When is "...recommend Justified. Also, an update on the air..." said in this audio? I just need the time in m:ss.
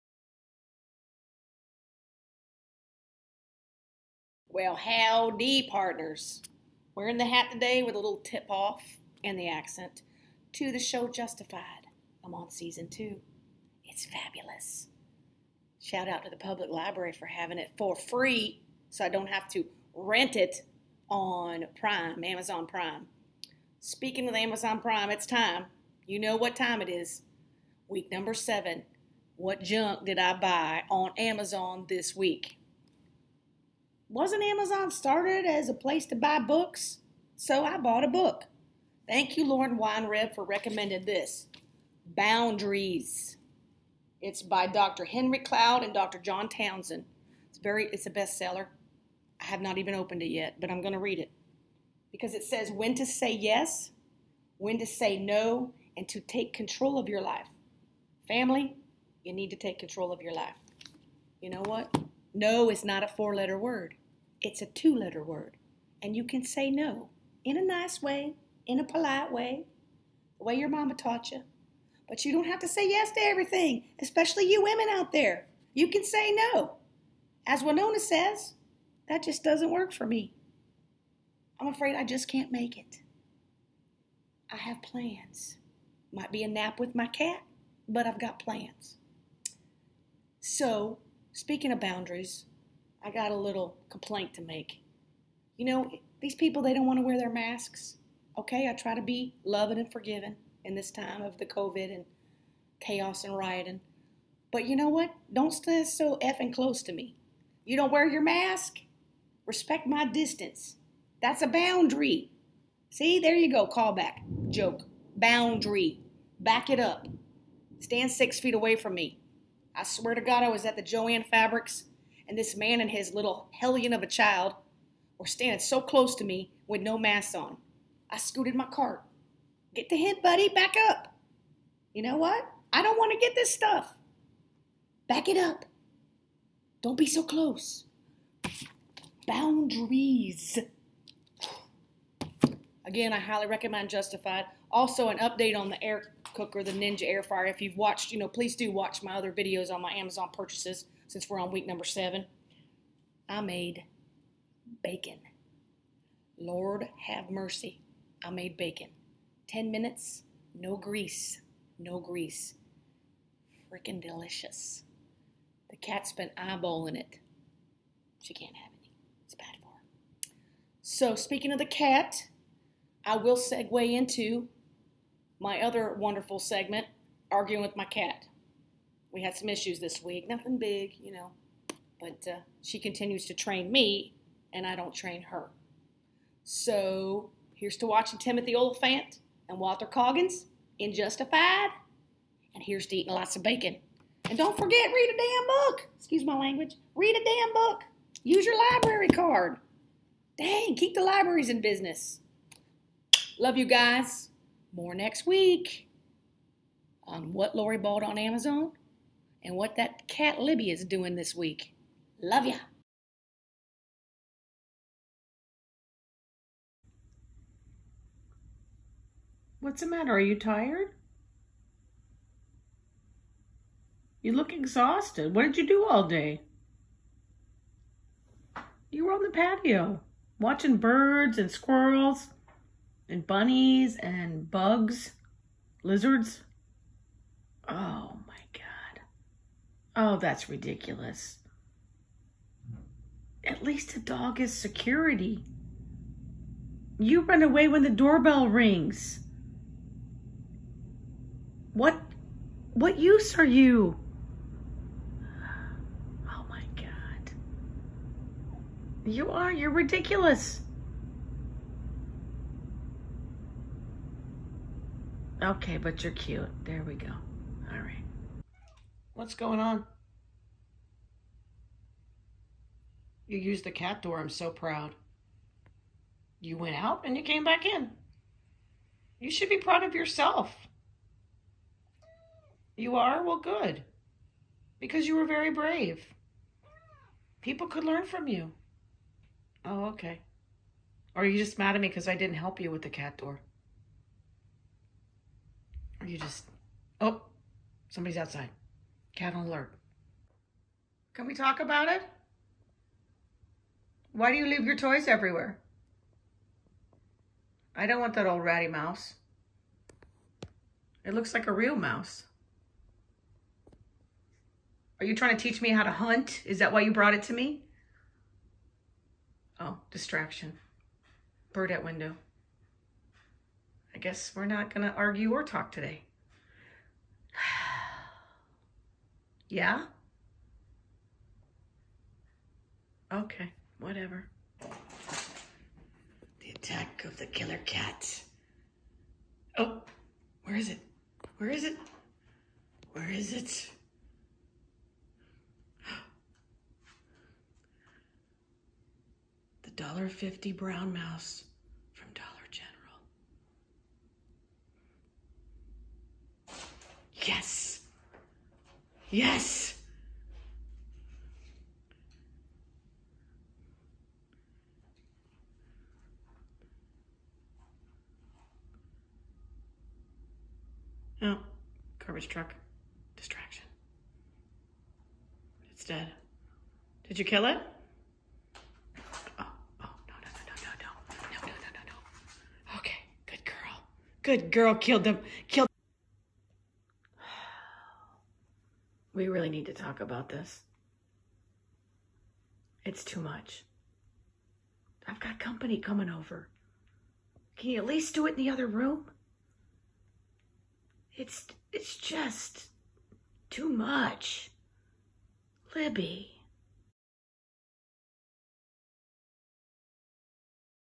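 2:23.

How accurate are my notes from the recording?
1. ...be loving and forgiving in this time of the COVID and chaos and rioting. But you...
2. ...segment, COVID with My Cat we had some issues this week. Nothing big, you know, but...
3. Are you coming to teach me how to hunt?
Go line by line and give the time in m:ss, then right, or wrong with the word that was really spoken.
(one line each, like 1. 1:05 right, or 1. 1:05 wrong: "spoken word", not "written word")
1. 1:39 right
2. 2:56 wrong: "Arguing", not "COVID"
3. 5:14 wrong: "trying", not "coming".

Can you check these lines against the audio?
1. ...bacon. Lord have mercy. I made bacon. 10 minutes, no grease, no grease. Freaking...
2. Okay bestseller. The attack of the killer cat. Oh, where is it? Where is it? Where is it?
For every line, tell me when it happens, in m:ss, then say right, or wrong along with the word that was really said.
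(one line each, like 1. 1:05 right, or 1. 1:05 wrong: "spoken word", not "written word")
1. 2:34 right
2. 5:33 wrong: "whatever", not "bestseller".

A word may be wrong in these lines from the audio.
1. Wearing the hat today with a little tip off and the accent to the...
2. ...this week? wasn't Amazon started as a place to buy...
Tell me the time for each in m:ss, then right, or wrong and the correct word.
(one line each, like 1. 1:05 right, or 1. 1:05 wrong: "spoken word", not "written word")
1. 0:06 right
2. 0:31 right.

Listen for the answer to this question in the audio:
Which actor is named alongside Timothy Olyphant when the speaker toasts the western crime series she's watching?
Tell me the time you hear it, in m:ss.
3:09.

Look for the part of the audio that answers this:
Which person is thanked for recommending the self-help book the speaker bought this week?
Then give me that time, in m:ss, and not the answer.
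0:39.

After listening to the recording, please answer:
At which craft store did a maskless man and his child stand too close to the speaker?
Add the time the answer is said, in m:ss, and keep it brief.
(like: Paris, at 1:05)
Jo-Ann Fabrics, at 2:00.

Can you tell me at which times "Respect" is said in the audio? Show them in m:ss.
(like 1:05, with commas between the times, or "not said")
1:49.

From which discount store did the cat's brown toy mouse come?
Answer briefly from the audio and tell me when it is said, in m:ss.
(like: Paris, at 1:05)
Dollar General, at 5:52.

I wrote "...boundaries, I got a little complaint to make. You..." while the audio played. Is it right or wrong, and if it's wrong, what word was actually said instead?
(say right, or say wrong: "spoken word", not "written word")
right.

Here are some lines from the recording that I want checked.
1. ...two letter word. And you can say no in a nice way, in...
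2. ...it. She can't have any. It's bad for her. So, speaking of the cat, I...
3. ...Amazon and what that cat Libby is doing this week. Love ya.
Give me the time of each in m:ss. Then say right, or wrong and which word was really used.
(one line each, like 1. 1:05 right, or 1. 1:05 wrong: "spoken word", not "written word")
1. 1:04 right
2. 2:46 right
3. 3:28 right.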